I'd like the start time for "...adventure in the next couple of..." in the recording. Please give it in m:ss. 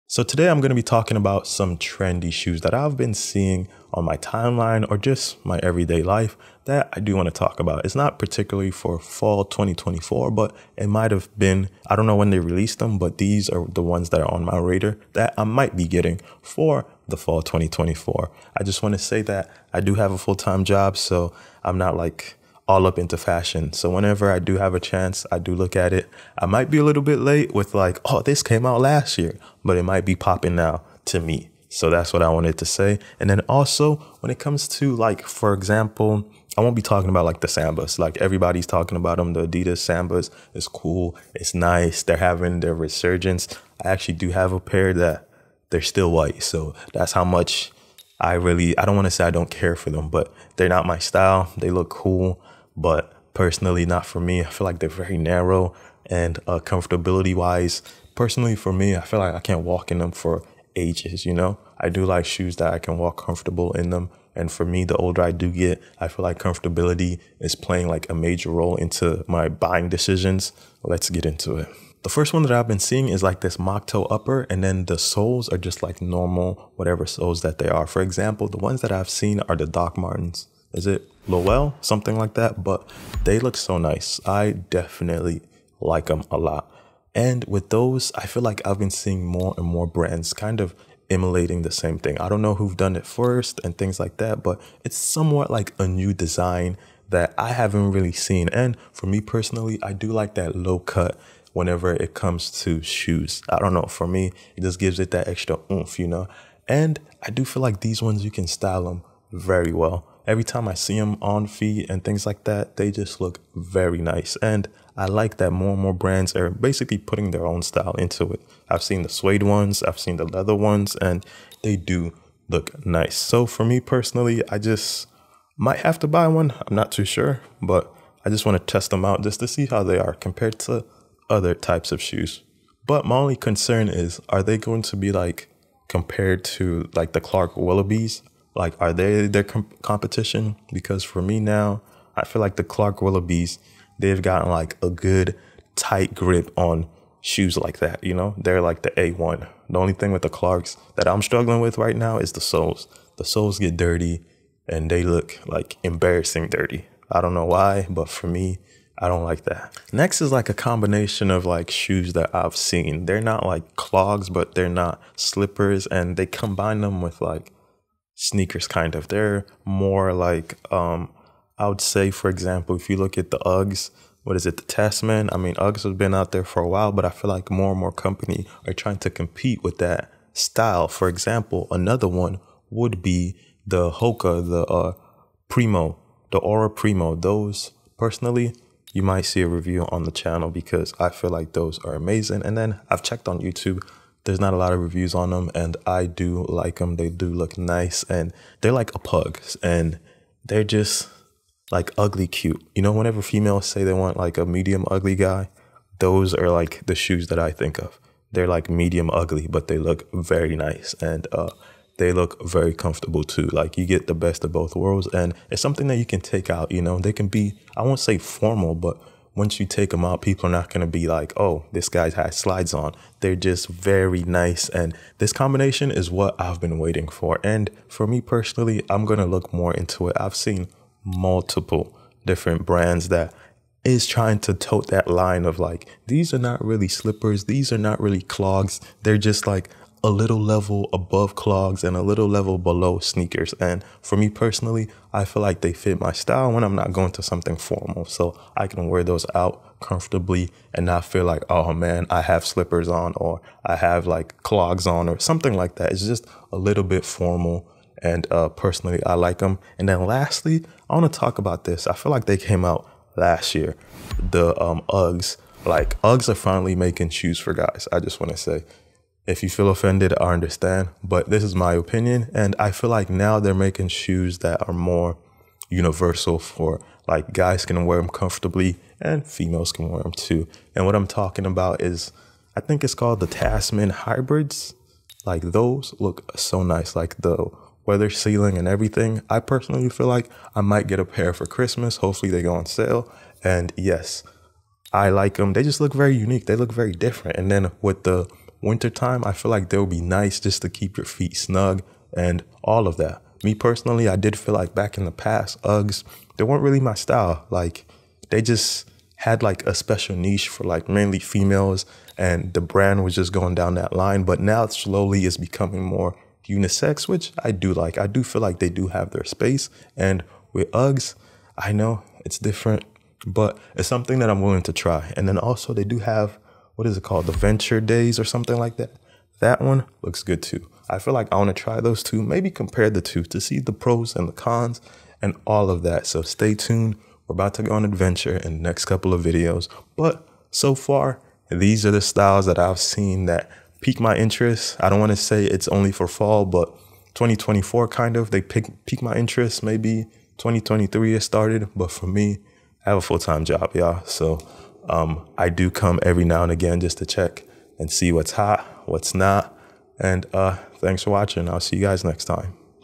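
5:37.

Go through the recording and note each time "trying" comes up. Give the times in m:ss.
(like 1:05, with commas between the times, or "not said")
2:58, 3:54.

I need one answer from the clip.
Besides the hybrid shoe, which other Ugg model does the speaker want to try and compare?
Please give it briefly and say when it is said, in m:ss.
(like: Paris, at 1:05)
Venture Daze, at 5:27.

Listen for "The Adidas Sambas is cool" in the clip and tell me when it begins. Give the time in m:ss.
0:39.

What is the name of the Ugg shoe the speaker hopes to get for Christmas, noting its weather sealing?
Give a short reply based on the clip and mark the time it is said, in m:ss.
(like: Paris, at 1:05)
Tasman Hybrids, at 4:43.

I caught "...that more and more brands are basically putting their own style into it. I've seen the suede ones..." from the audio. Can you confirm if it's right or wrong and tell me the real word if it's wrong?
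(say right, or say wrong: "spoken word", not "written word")
right.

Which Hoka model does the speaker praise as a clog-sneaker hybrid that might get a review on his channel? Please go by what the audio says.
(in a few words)
Ora Primo.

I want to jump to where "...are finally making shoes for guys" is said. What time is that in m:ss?
4:26.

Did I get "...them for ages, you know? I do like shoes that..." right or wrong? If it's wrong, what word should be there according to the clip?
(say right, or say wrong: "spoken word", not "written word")
right.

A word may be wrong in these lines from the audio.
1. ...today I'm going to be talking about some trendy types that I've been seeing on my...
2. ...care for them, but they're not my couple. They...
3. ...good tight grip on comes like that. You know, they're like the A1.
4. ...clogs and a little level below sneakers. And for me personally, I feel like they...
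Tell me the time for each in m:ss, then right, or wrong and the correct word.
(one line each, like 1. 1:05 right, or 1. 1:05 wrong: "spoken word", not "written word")
1. 0:00 wrong: "shoes", not "types"
2. 0:49 wrong: "style", not "couple"
3. 2:24 wrong: "shoes", not "comes"
4. 4:01 right.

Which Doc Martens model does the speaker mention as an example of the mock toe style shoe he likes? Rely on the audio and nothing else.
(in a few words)
Lowell.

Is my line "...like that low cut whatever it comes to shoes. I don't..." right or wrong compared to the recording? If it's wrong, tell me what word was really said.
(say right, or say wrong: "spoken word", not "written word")
wrong: "whenever", not "whatever".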